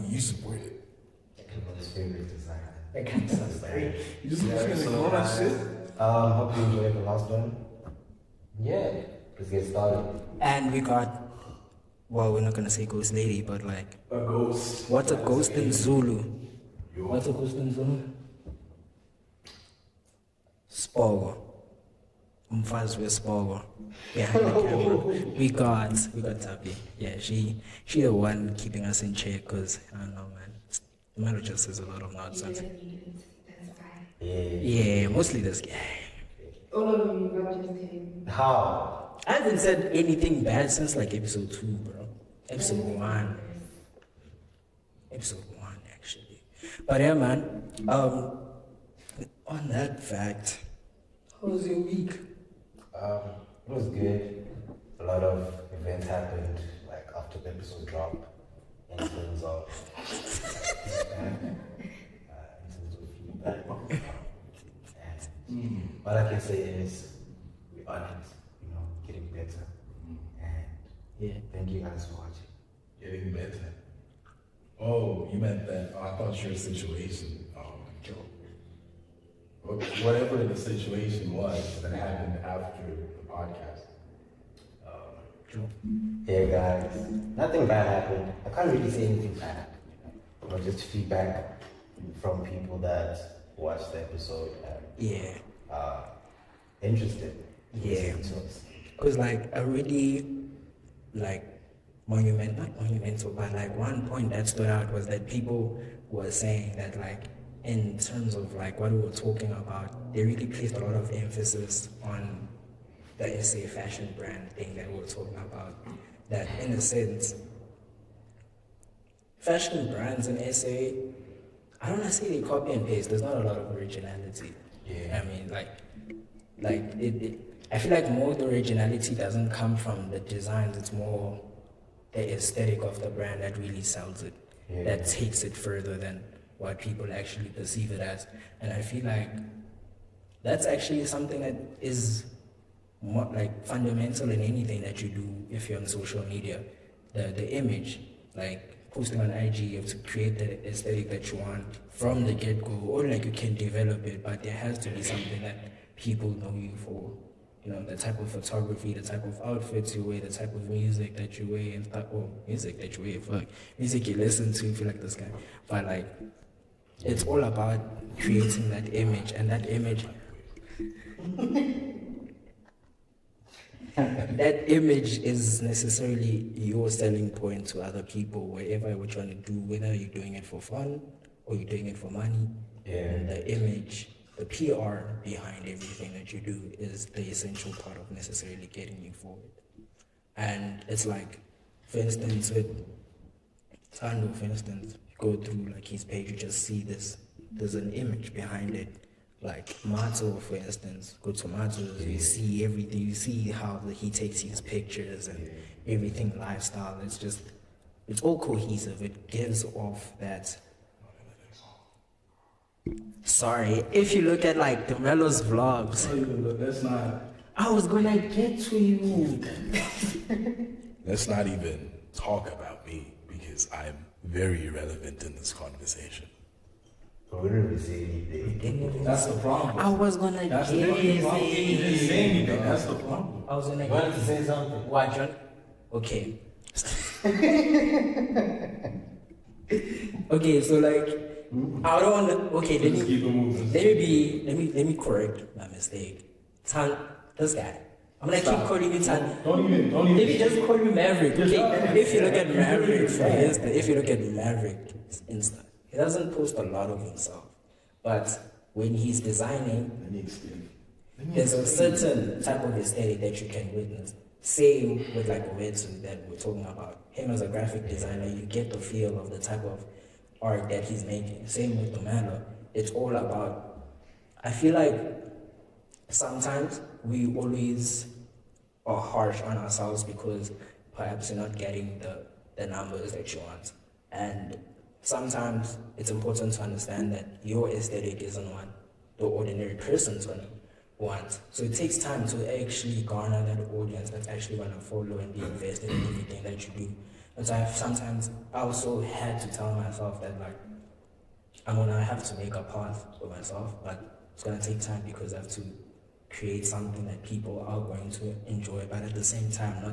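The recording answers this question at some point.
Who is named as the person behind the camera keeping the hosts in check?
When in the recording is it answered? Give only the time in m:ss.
0:26.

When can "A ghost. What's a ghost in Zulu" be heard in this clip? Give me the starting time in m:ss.
0:14.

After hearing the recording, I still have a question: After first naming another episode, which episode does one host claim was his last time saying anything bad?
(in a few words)
Episode one.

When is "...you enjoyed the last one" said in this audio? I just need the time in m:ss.
0:06.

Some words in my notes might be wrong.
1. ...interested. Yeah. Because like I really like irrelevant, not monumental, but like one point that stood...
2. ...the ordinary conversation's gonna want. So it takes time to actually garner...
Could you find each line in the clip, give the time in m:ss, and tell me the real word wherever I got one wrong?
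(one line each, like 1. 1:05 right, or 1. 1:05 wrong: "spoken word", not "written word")
1. 1:36 wrong: "monument", not "irrelevant"
2. 4:49 wrong: "person", not "conversation".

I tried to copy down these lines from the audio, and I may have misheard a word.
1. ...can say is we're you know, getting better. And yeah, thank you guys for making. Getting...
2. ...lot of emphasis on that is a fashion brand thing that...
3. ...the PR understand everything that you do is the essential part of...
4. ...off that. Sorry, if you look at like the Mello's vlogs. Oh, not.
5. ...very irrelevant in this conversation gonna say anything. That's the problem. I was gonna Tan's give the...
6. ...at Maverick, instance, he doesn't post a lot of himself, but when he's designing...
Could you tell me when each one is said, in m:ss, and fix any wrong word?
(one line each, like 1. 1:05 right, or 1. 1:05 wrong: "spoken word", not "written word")
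1. 1:06 wrong: "watching", not "making"
2. 1:50 right
3. 3:04 wrong: "behind", not "understand"
4. 3:29 right
5. 3:44 wrong: "That", not "Tan"
6. 4:14 right.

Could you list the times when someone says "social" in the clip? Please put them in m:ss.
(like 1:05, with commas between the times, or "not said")
2:25.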